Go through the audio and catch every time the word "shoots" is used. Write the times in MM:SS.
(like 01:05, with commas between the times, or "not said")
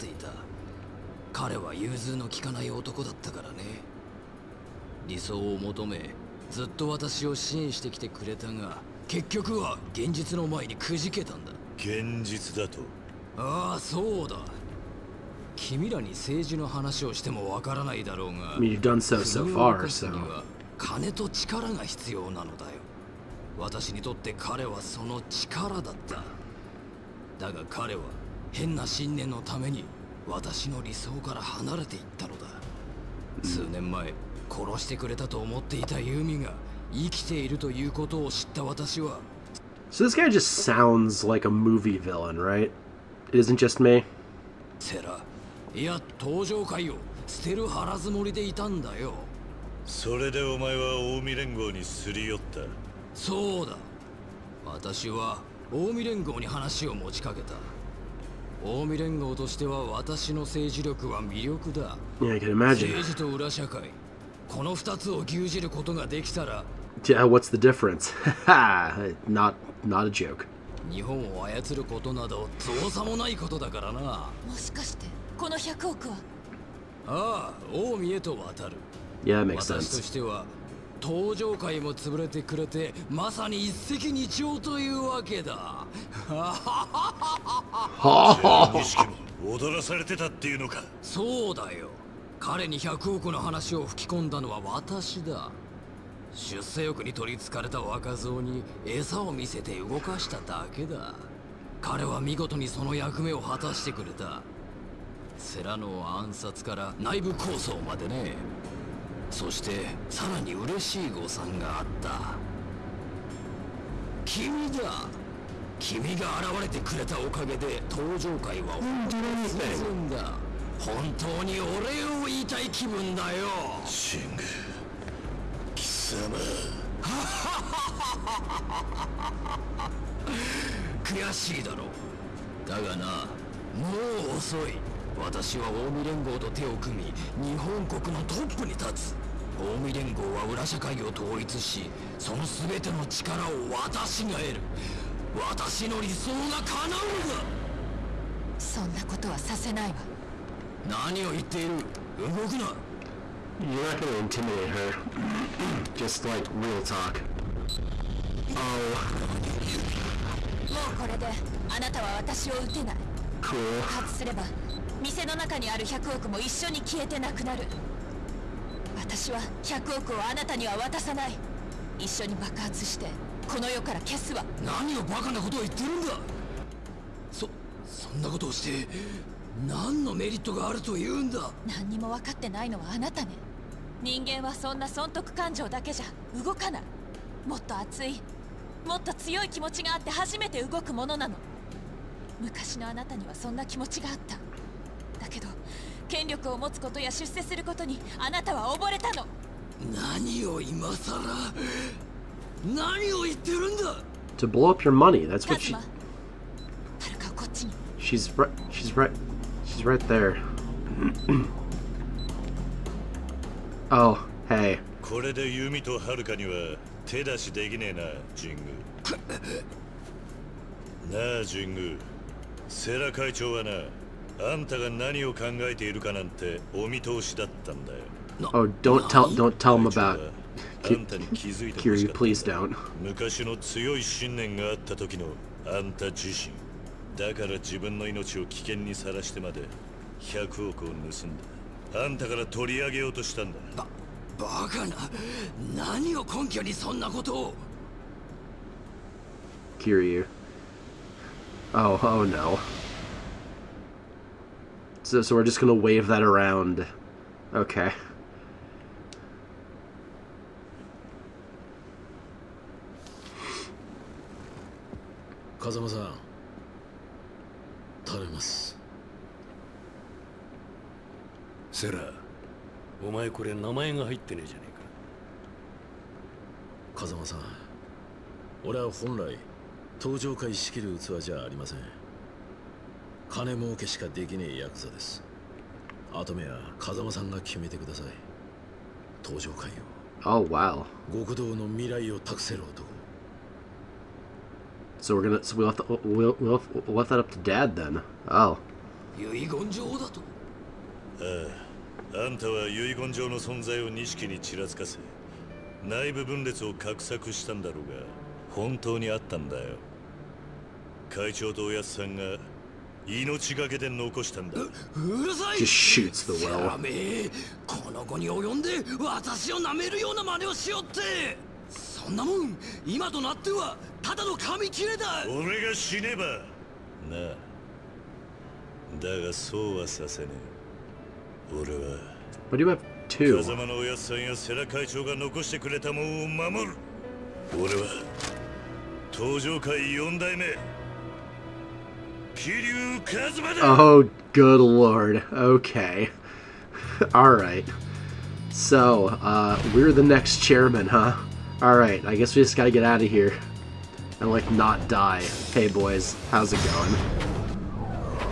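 05:16.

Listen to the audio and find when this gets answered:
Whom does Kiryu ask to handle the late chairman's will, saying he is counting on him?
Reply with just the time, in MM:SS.
04:25.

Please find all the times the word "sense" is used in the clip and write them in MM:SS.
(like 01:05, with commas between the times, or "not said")
01:19.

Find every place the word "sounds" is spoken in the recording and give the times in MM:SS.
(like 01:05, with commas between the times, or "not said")
00:40.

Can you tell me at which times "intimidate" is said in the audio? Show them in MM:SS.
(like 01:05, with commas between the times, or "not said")
02:34.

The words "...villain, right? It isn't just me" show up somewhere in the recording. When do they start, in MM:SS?
00:41.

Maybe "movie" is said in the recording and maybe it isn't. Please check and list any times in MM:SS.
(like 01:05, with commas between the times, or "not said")
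00:41.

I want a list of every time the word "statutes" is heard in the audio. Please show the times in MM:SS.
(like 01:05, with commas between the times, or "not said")
not said.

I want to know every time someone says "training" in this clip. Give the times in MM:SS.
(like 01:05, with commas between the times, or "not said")
not said.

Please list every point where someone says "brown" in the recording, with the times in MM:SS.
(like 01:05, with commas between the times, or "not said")
not said.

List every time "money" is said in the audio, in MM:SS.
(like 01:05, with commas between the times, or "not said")
03:24.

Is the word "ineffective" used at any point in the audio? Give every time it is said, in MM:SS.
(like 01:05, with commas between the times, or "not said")
not said.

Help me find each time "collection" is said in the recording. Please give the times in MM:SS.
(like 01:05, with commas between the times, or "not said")
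not said.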